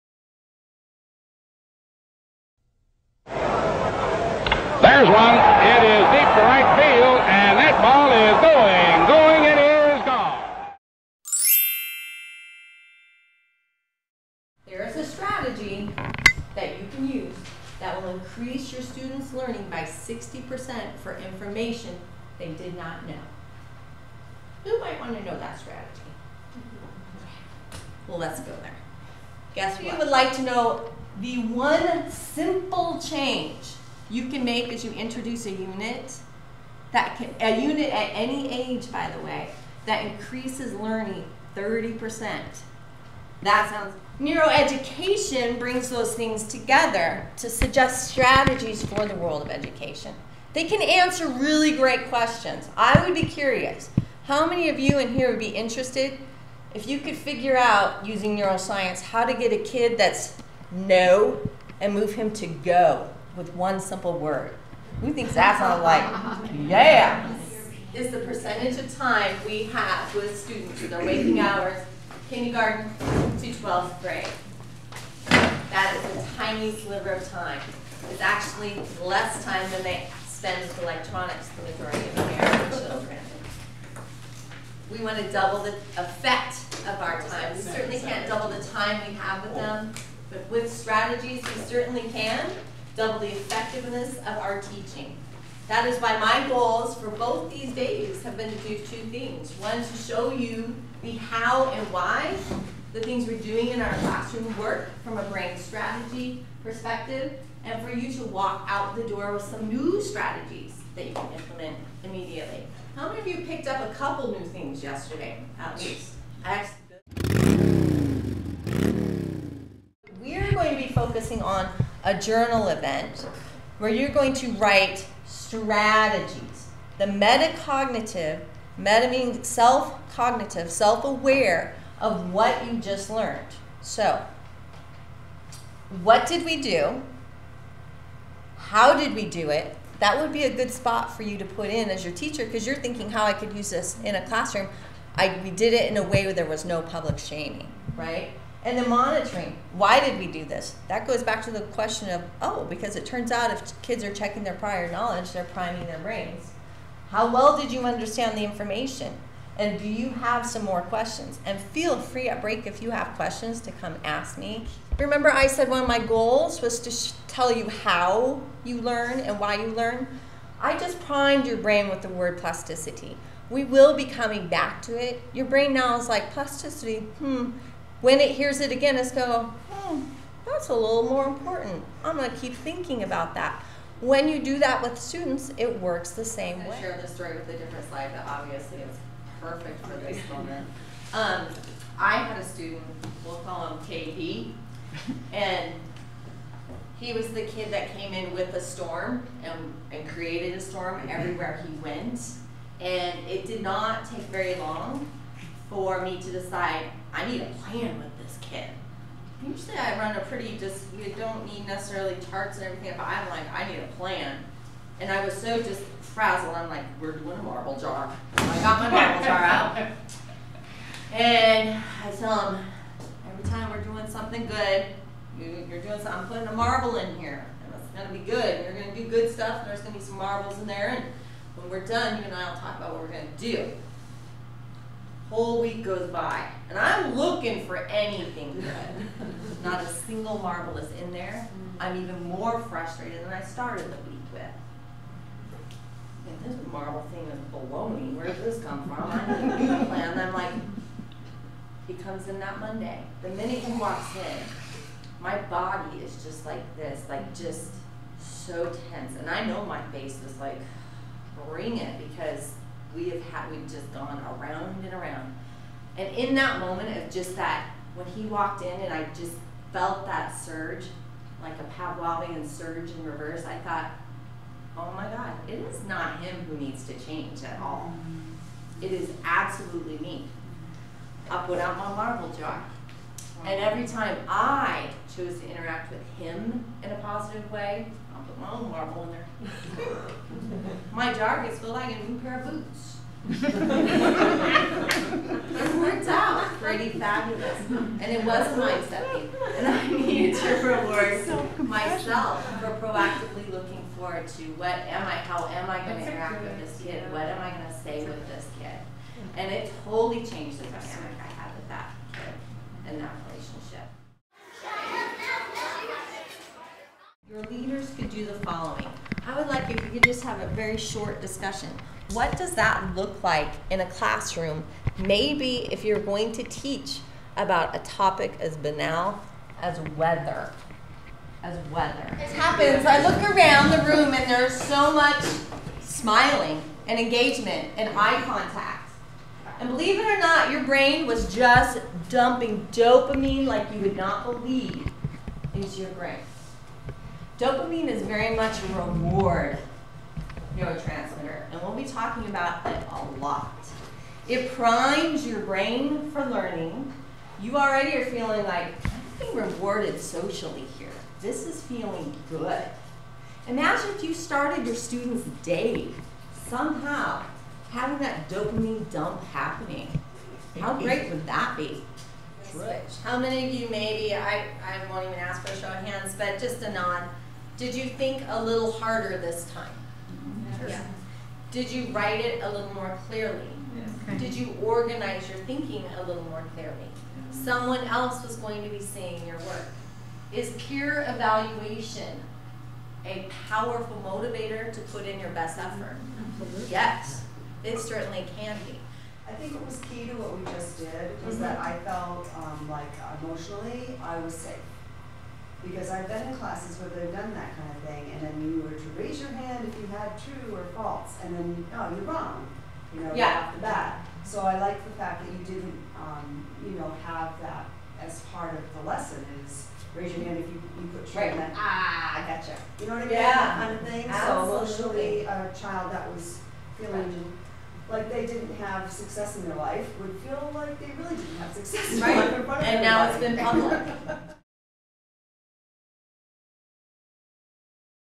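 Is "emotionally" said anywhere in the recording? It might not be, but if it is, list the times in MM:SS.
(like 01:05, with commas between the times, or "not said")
06:43, 07:04.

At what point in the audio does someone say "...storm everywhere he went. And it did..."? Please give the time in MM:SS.
03:20.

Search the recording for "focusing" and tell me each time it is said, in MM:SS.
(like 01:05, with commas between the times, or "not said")
02:00.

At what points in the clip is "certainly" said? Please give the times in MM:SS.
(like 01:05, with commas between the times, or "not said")
01:27, 01:31, 06:37.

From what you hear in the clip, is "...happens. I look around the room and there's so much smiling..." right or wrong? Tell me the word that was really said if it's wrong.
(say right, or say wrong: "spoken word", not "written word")
right.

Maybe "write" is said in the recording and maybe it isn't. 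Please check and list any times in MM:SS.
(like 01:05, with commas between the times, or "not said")
02:04, 06:21.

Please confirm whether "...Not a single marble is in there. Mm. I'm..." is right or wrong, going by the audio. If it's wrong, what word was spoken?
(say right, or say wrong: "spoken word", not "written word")
right.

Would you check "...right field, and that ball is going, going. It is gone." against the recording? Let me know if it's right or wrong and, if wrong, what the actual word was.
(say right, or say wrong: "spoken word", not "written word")
right.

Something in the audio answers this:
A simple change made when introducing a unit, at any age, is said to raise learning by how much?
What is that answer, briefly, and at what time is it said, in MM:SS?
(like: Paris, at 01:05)
30%, at 00:41.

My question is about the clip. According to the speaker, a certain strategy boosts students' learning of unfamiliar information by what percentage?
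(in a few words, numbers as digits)
60%.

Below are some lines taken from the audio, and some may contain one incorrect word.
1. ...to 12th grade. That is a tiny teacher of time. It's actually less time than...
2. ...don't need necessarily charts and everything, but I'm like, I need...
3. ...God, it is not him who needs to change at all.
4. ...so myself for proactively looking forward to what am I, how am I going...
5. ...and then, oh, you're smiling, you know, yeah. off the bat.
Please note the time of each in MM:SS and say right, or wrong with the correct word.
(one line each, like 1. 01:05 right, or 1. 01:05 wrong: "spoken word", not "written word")
1. 01:12 wrong: "sliver", not "teacher"
2. 03:31 right
3. 04:35 right
4. 05:01 right
5. 06:51 wrong: "wrong", not "smiling".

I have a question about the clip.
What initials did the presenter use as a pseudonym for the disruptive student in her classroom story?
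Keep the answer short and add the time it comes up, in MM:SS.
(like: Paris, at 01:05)
KB, at 03:13.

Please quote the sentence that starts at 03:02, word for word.
I'm going to keep thinking about that.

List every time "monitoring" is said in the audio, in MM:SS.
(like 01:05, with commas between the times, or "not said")
02:28.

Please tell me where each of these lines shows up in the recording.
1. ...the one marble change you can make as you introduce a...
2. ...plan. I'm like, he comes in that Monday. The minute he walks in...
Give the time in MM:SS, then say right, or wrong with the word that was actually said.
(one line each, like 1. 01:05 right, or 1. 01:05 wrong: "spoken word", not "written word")
1. 00:31 wrong: "simple", not "marble"
2. 04:09 right.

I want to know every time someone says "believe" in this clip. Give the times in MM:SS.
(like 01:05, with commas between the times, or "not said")
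05:39, 05:44.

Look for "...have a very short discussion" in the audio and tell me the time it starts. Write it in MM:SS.
05:20.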